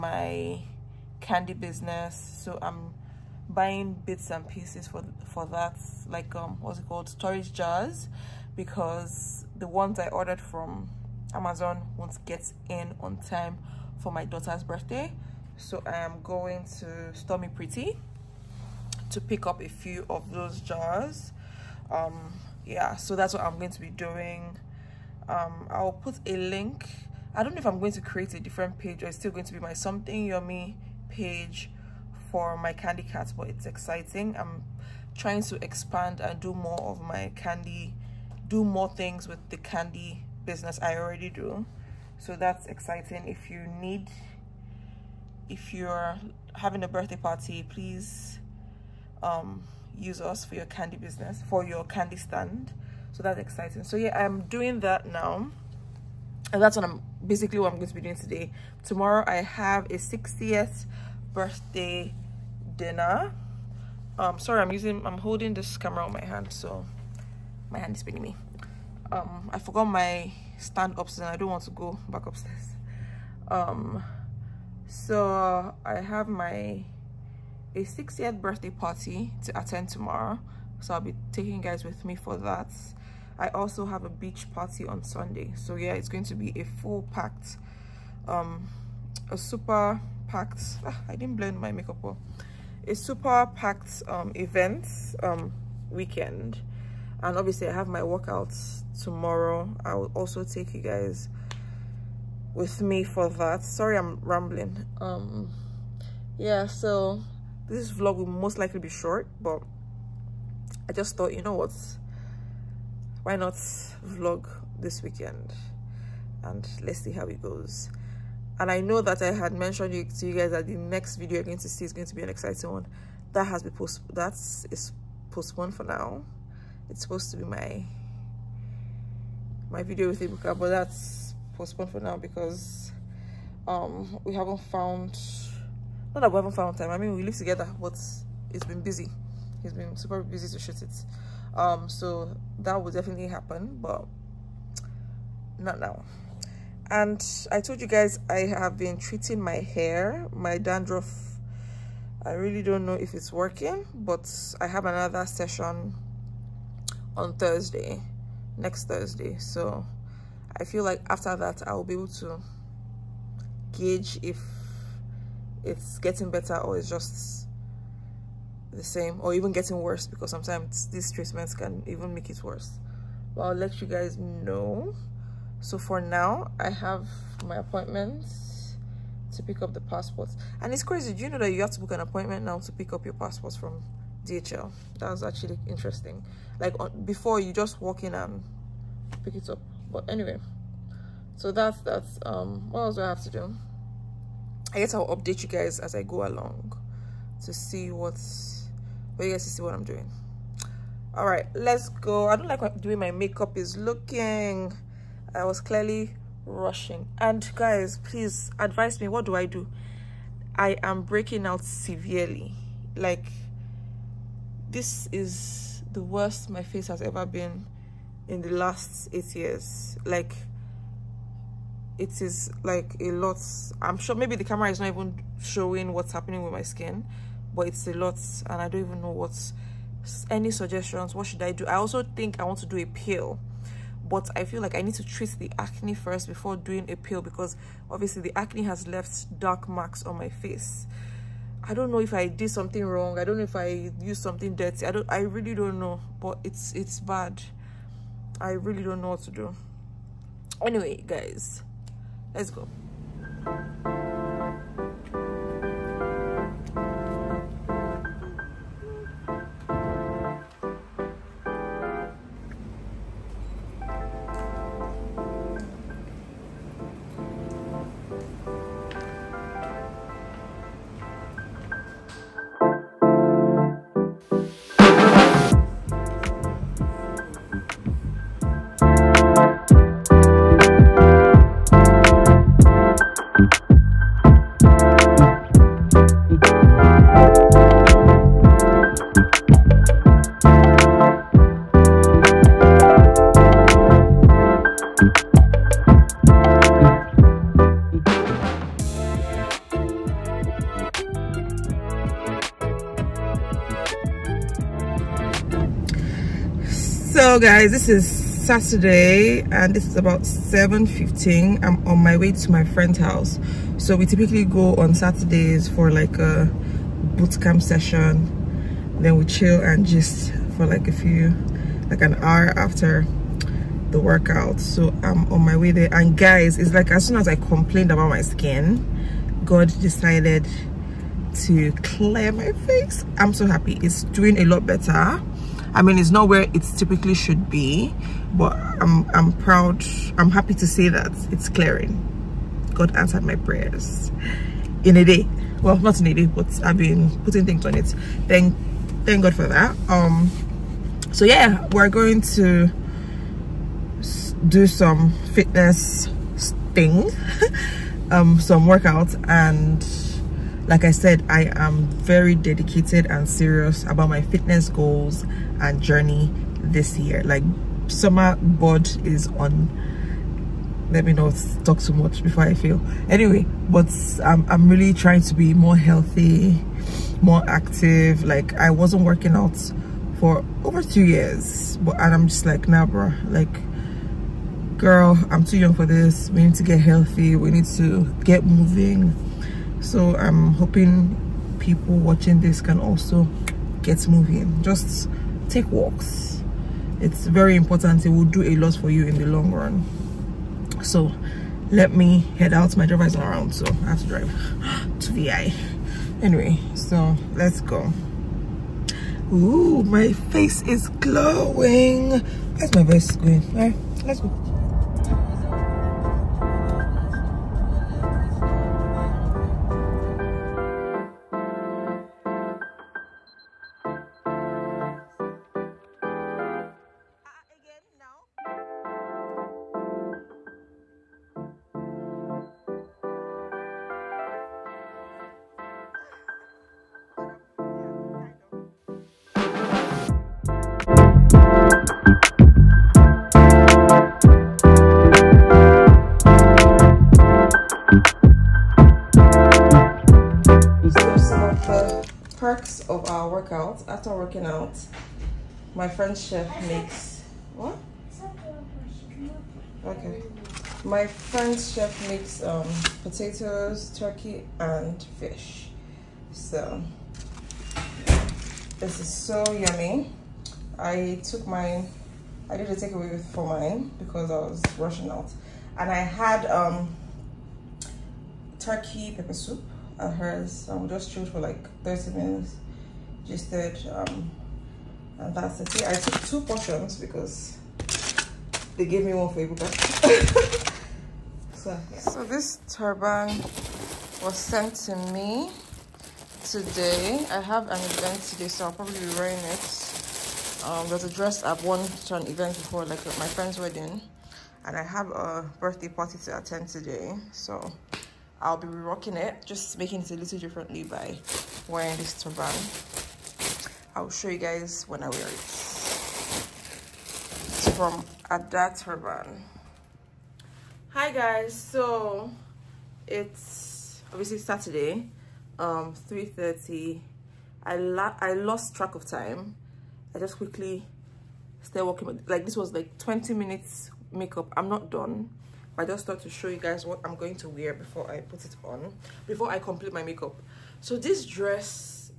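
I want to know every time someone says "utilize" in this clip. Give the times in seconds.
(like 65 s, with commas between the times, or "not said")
not said.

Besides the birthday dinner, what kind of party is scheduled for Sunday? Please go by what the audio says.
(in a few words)
Beach party.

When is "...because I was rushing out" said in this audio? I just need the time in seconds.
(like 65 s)
473 s.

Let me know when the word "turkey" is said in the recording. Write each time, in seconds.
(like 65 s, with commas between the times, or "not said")
463 s, 478 s.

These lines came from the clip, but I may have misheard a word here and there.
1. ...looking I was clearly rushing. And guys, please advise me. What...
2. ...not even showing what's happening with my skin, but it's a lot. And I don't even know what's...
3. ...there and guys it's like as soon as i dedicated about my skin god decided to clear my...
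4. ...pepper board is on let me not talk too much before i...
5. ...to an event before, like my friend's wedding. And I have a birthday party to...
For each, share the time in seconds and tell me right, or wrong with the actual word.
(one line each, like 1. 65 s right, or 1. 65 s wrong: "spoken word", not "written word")
1. 203 s right
2. 224 s right
3. 325 s wrong: "complained", not "dedicated"
4. 367 s wrong: "summer", not "pepper"
5. 501 s right.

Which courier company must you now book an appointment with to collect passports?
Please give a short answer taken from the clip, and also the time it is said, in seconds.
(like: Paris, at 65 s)
DHL, at 184 s.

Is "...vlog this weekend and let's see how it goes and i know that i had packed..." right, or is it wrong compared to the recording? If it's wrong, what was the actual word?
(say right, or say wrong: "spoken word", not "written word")
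wrong: "mentioned", not "packed".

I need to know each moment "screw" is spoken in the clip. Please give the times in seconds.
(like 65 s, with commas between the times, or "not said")
not said.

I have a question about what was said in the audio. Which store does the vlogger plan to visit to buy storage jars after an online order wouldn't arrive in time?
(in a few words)
Stormy Pretty.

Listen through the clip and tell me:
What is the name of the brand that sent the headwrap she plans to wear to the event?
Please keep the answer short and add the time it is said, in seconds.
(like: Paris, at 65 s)
Ada Turban, at 518 s.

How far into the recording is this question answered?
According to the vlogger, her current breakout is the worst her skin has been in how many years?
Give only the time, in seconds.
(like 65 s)
219 s.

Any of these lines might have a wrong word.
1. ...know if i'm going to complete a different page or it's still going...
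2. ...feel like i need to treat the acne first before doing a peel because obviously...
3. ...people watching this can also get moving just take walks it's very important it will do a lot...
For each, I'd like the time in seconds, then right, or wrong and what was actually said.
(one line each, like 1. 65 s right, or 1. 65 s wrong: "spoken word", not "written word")
1. 27 s wrong: "create", not "complete"
2. 234 s right
3. 391 s right.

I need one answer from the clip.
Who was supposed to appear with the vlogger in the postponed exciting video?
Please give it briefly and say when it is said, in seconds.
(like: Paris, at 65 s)
Ebuka, at 130 s.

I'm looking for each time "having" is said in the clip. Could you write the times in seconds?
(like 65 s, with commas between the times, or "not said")
46 s.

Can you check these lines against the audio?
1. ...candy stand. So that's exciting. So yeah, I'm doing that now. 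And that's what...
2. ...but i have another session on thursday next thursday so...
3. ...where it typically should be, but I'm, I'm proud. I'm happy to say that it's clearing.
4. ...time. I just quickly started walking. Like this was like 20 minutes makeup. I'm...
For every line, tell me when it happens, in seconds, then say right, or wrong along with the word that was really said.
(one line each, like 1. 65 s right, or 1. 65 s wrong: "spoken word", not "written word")
1. 51 s right
2. 153 s right
3. 336 s right
4. 529 s right.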